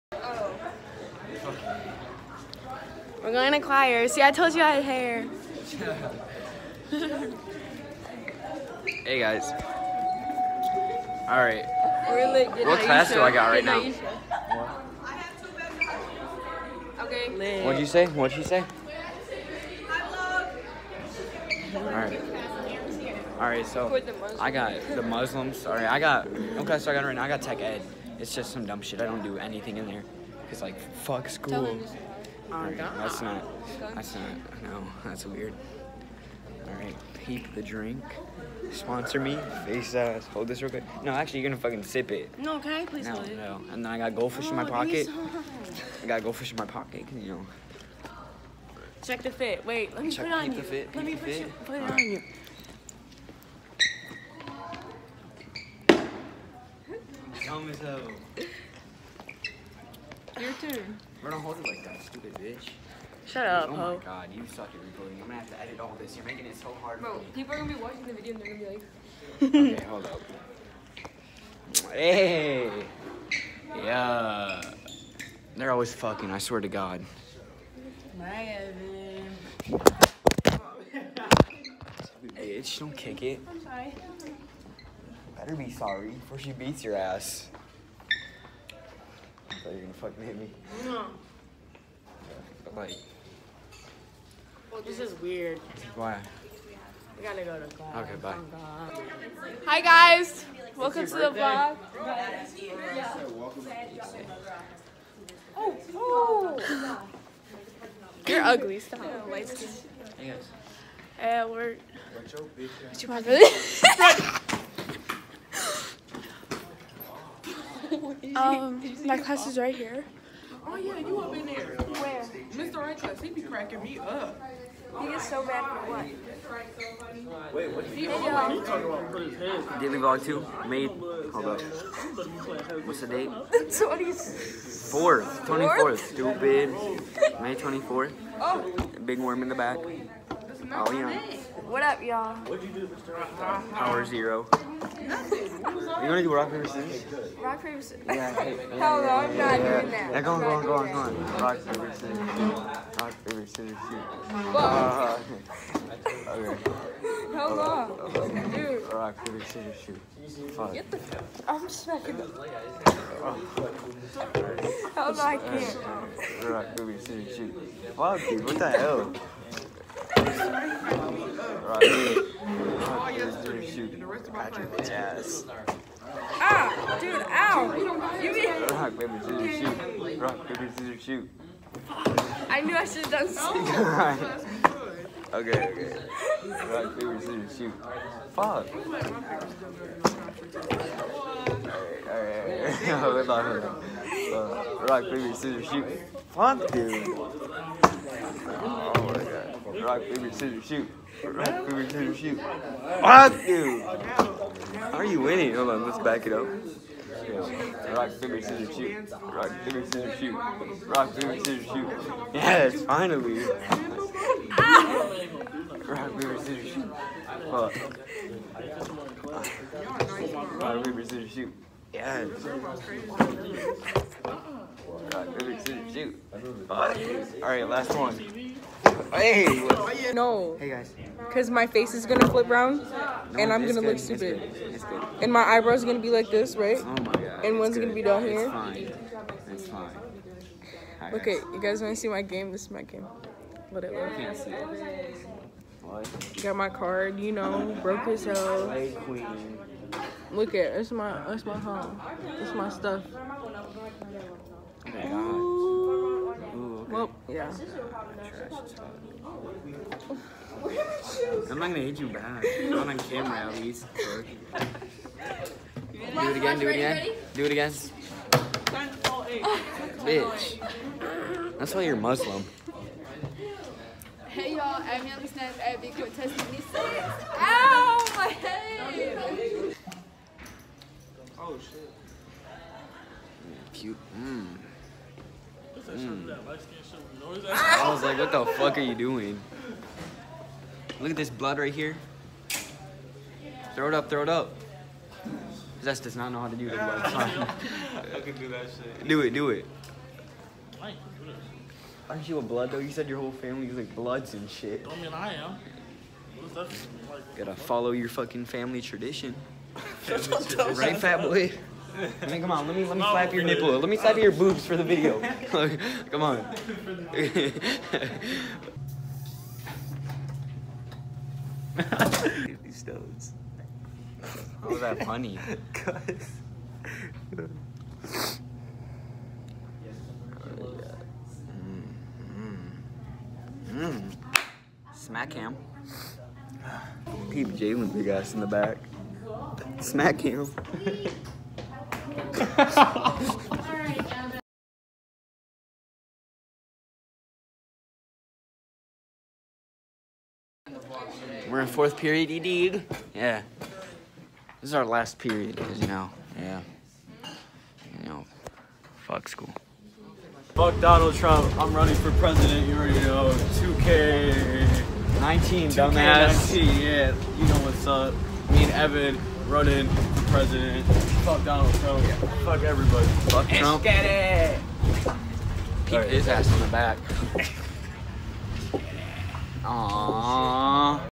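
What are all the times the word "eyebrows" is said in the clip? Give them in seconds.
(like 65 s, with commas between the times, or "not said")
235 s.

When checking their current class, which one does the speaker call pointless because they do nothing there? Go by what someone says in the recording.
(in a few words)
Tech ed.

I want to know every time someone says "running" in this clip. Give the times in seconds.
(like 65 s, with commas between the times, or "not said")
361 s, 369 s.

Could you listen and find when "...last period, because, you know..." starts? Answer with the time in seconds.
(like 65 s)
354 s.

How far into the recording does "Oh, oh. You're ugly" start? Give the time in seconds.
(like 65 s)
105 s.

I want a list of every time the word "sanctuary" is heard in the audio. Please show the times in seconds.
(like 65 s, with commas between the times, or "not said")
not said.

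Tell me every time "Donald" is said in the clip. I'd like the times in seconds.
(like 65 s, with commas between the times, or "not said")
360 s, 371 s.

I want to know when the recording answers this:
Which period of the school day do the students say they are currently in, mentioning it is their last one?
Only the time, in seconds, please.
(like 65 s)
351 s.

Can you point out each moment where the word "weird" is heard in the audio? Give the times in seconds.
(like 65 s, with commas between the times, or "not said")
35 s, 95 s.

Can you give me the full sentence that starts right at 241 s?
you guys wanna see my game?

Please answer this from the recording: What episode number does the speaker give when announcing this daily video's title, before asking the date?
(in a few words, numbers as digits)
2.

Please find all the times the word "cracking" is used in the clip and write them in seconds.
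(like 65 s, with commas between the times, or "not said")
123 s.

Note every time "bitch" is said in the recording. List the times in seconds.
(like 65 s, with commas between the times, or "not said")
62 s, 82 s, 270 s.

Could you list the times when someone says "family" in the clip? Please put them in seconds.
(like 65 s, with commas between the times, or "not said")
303 s, 308 s.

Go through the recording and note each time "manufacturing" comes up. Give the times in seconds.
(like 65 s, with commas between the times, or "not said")
not said.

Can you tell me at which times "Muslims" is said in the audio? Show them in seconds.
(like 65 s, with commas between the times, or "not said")
25 s, 271 s.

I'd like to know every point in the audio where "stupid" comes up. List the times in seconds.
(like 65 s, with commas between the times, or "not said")
62 s, 135 s, 233 s.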